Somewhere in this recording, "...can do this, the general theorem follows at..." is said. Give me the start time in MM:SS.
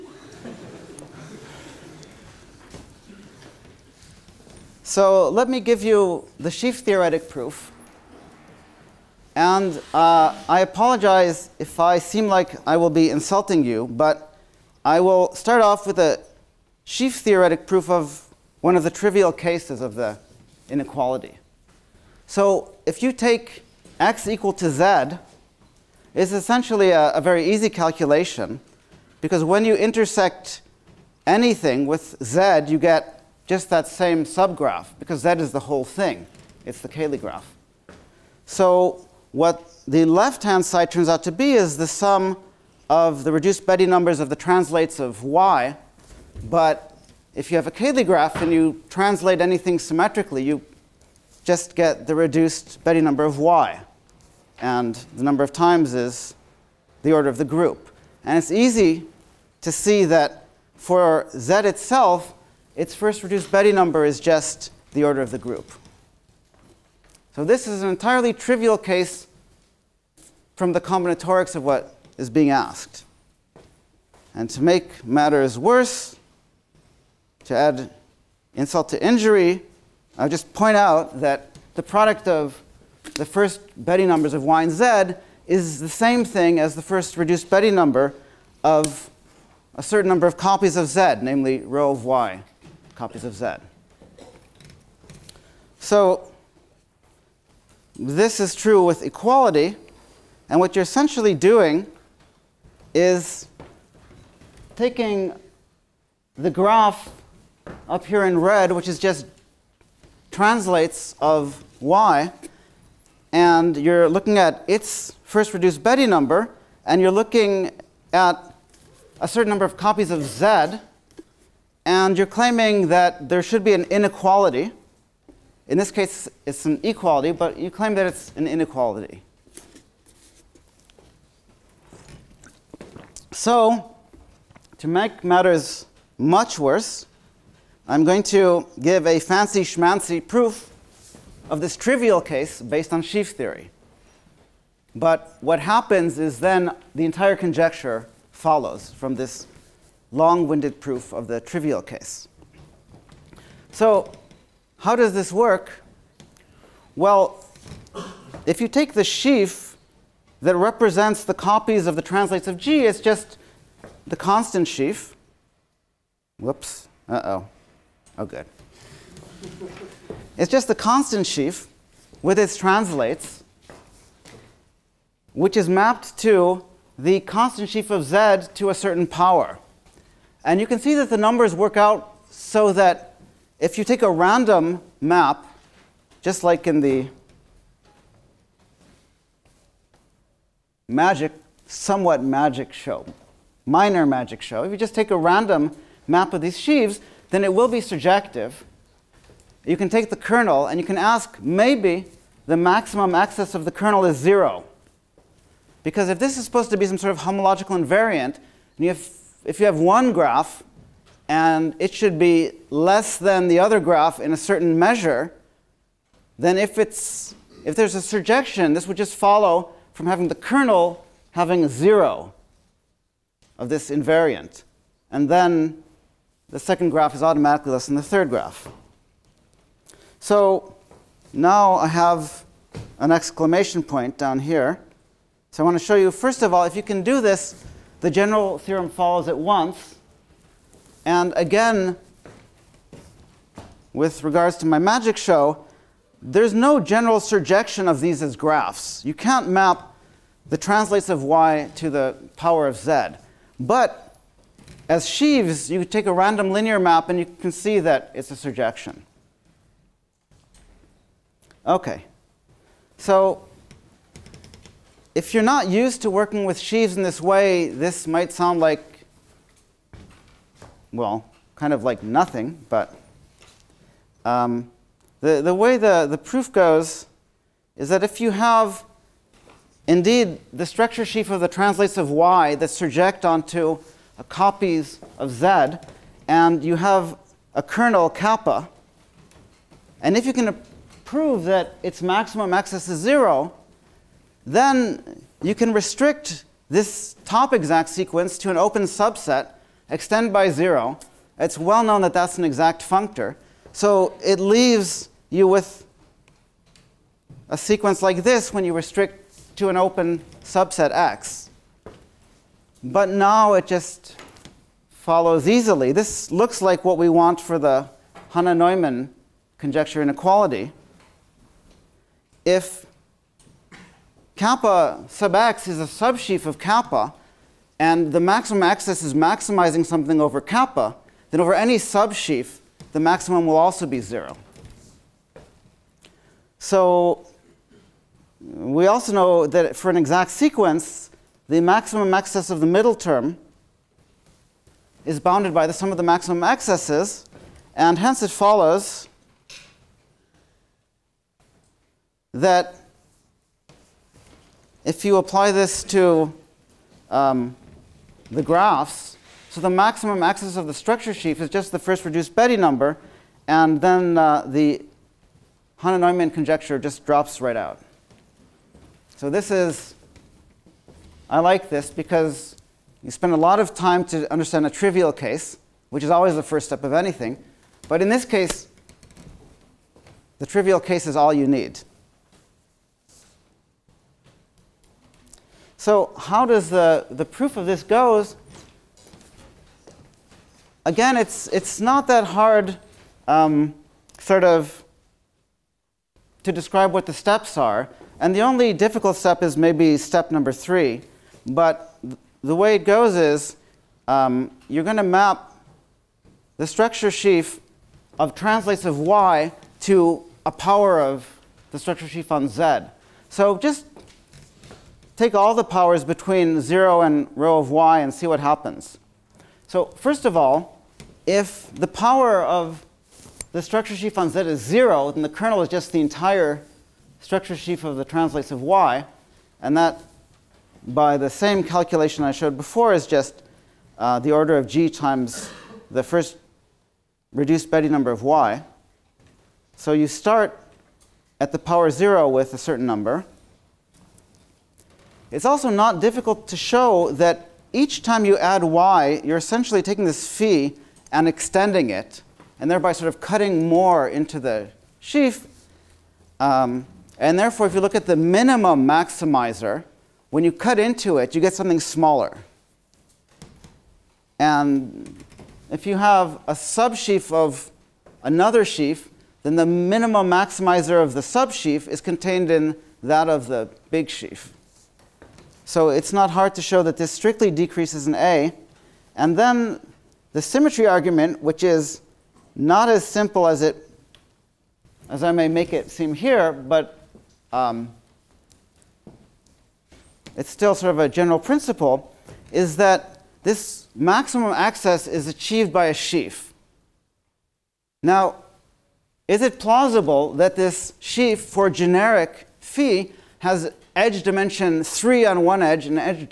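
03:56.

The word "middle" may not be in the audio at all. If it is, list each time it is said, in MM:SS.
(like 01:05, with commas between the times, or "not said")
05:42.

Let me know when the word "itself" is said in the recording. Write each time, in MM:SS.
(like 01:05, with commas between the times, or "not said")
01:01.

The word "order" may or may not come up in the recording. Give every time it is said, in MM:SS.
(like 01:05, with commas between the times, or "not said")
00:57, 01:05, 07:14.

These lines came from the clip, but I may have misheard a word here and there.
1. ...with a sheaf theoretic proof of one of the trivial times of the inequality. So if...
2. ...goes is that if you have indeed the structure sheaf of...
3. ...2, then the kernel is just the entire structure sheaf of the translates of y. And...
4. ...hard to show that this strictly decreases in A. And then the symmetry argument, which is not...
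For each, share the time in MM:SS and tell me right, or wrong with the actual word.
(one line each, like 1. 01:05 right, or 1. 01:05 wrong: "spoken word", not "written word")
1. 00:15 wrong: "cases", not "times"
2. 04:36 right
3. 07:04 wrong: "0", not "2"
4. 07:56 right.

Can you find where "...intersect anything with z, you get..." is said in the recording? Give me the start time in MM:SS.
00:29.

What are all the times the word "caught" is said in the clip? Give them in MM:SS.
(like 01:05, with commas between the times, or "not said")
not said.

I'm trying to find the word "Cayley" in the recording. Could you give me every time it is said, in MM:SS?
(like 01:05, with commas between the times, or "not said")
00:36, 00:47.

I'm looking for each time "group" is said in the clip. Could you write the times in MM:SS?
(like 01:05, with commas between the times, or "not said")
00:57, 01:05.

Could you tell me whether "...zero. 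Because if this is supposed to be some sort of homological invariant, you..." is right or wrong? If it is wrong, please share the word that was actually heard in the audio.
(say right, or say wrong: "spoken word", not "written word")
right.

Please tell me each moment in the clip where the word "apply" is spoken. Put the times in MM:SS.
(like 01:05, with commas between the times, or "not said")
05:55.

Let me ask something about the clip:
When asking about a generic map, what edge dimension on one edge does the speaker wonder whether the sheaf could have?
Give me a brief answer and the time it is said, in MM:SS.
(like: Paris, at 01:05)
3, at 08:23.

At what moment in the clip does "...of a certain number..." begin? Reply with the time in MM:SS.
01:28.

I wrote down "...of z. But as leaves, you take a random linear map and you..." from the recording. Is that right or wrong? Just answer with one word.
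wrong.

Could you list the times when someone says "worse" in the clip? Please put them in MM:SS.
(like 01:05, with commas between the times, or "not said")
01:15, 02:16.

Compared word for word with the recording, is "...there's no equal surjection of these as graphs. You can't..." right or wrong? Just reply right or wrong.
wrong.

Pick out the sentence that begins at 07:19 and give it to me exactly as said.
So you start at the power 0 with a certain number.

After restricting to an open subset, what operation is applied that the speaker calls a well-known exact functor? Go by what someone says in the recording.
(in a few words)
extend by zero.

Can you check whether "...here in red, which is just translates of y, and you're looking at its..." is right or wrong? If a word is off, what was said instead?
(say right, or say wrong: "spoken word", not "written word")
right.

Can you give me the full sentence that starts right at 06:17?
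But in this case, the trivial case is all you need.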